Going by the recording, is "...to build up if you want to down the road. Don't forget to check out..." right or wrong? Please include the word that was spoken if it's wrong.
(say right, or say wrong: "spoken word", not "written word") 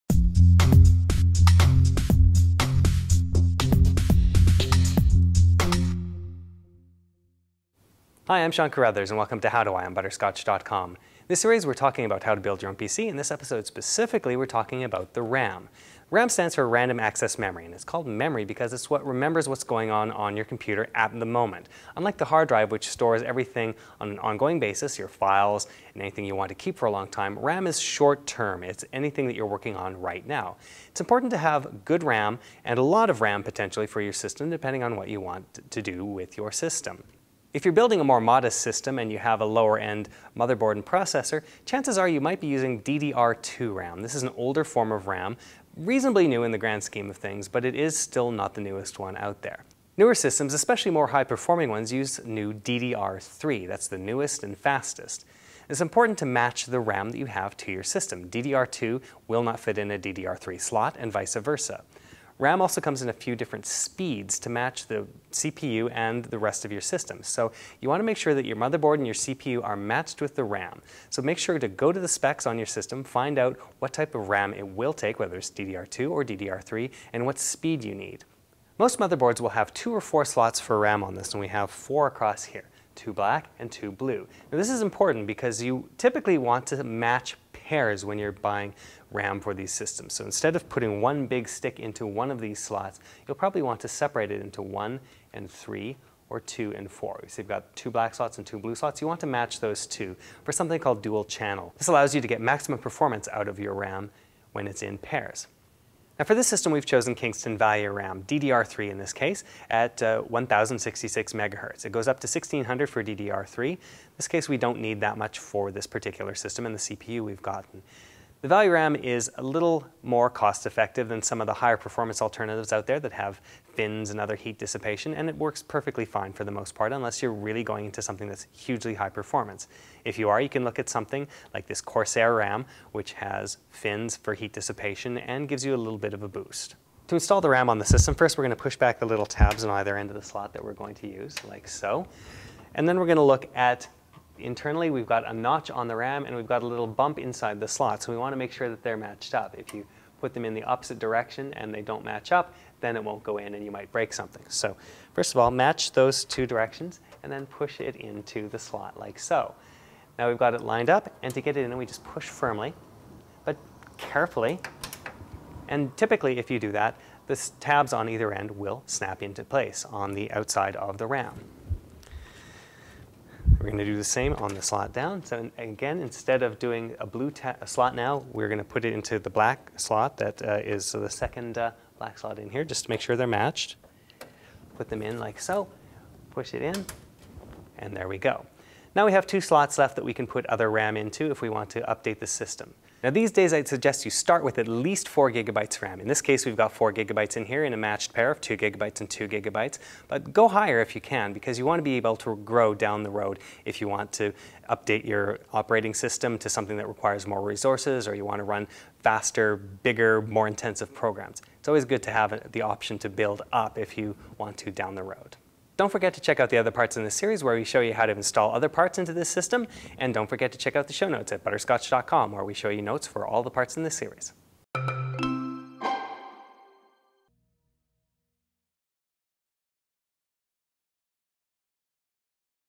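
right.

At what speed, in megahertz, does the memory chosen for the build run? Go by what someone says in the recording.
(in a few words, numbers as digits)
1066.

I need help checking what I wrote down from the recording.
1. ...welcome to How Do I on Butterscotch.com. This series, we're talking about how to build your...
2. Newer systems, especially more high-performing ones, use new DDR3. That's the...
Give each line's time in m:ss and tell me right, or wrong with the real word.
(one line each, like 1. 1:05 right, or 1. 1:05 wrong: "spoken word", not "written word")
1. 0:09 right
2. 0:49 right.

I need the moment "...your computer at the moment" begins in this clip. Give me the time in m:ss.
0:20.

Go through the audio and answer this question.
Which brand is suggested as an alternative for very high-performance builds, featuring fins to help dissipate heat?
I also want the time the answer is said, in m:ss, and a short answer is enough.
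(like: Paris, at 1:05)
Corsair, at 2:11.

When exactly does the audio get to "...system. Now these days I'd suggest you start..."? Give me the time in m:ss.
3:12.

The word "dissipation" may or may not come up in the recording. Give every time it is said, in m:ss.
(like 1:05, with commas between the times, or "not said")
2:04, 2:14.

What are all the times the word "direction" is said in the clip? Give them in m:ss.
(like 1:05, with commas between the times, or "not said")
2:30, 2:36.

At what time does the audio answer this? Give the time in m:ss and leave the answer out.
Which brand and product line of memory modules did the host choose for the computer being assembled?
1:47.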